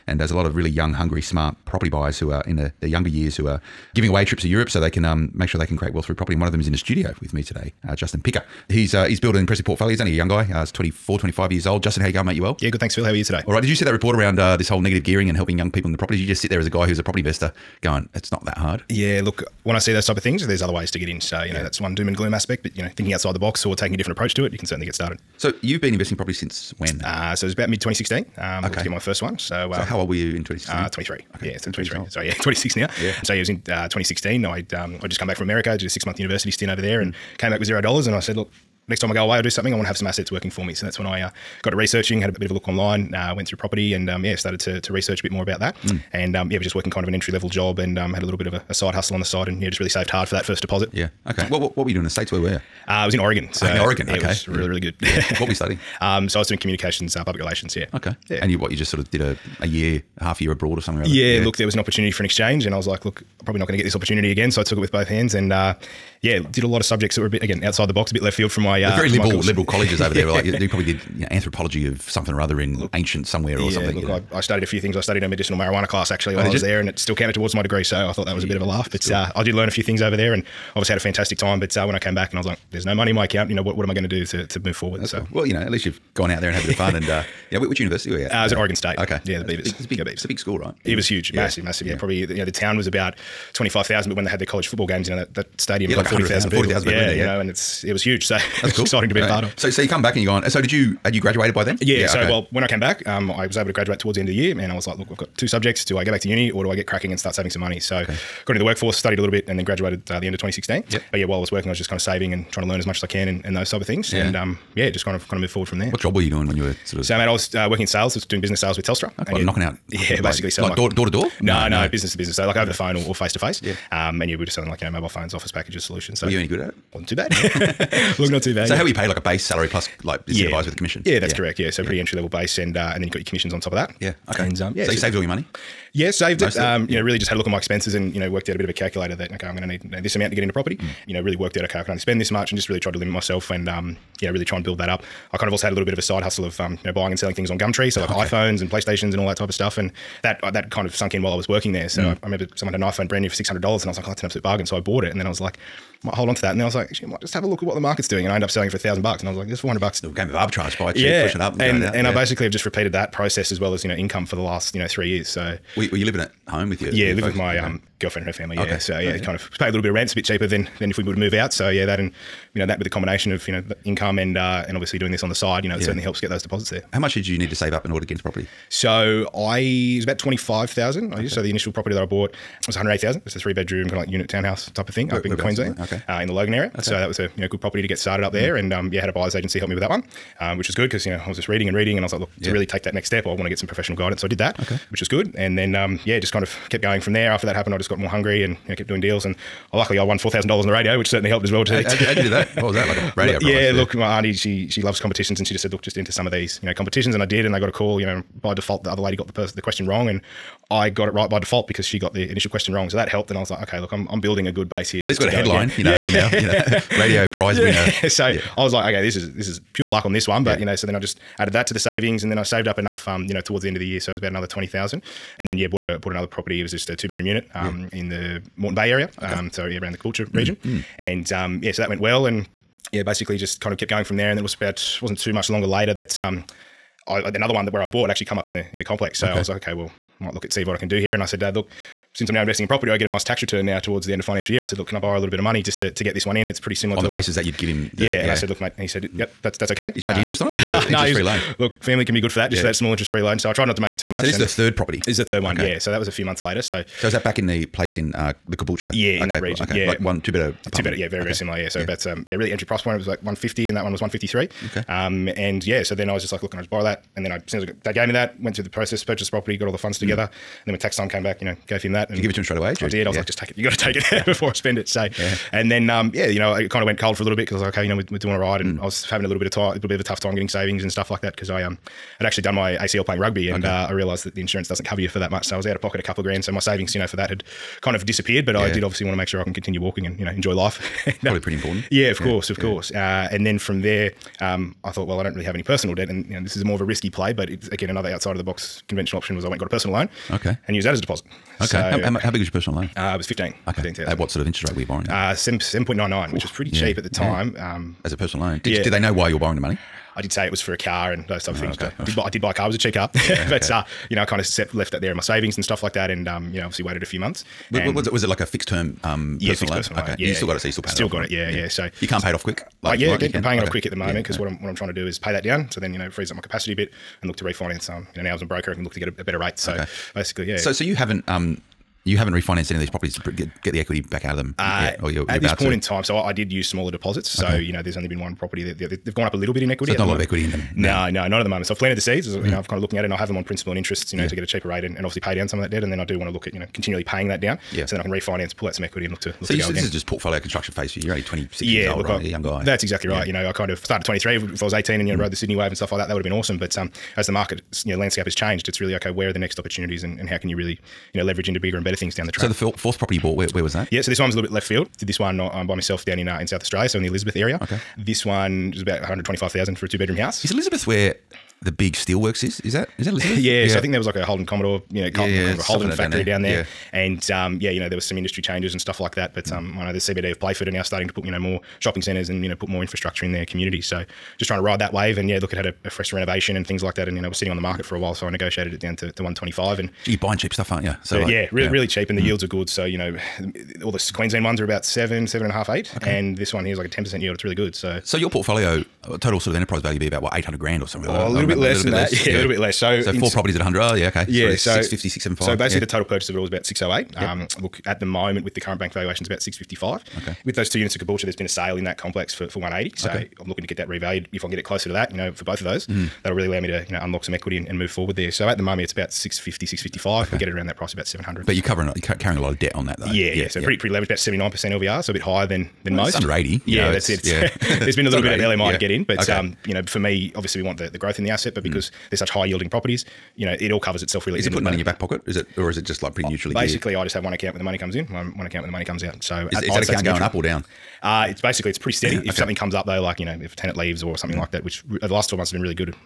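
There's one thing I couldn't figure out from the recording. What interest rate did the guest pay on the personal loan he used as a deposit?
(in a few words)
7.99%.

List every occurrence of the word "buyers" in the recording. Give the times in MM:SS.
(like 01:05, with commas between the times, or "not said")
00:01, 03:09.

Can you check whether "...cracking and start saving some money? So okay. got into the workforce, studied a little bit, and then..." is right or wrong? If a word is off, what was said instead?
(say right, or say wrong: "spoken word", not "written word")
right.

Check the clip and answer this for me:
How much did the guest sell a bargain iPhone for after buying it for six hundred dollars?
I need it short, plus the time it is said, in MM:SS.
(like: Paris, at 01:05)
$1,000, at 02:38.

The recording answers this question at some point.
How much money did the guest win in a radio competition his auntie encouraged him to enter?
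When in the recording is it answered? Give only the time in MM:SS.
03:20.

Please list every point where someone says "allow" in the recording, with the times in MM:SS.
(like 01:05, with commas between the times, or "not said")
06:56.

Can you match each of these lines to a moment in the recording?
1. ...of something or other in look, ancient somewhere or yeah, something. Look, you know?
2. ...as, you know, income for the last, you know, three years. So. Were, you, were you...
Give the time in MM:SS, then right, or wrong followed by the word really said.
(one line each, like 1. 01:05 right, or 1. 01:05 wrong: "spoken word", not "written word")
1. 01:11 right
2. 02:43 right.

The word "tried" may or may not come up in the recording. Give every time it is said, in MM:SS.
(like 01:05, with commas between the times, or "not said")
02:22, 04:13.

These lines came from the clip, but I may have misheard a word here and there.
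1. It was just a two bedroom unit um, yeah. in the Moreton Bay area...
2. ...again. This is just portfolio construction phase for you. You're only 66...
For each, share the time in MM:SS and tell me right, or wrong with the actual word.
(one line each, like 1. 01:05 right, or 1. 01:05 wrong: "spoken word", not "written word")
1. 03:46 right
2. 05:49 wrong: "26", not "66".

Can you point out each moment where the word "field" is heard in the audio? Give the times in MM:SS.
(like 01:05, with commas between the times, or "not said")
01:08, 06:04.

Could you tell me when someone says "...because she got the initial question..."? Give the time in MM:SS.
03:31.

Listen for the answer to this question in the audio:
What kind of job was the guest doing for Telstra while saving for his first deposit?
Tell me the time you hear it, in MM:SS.
01:58.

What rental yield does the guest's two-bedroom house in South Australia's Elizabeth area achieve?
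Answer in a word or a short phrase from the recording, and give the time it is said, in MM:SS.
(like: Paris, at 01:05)
10%, at 06:36.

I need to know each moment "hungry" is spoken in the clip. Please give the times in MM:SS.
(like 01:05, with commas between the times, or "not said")
00:00, 03:18.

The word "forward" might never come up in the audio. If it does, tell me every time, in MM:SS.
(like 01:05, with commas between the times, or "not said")
01:24, 01:55, 06:57.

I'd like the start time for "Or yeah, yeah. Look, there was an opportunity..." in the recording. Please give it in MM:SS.
01:01.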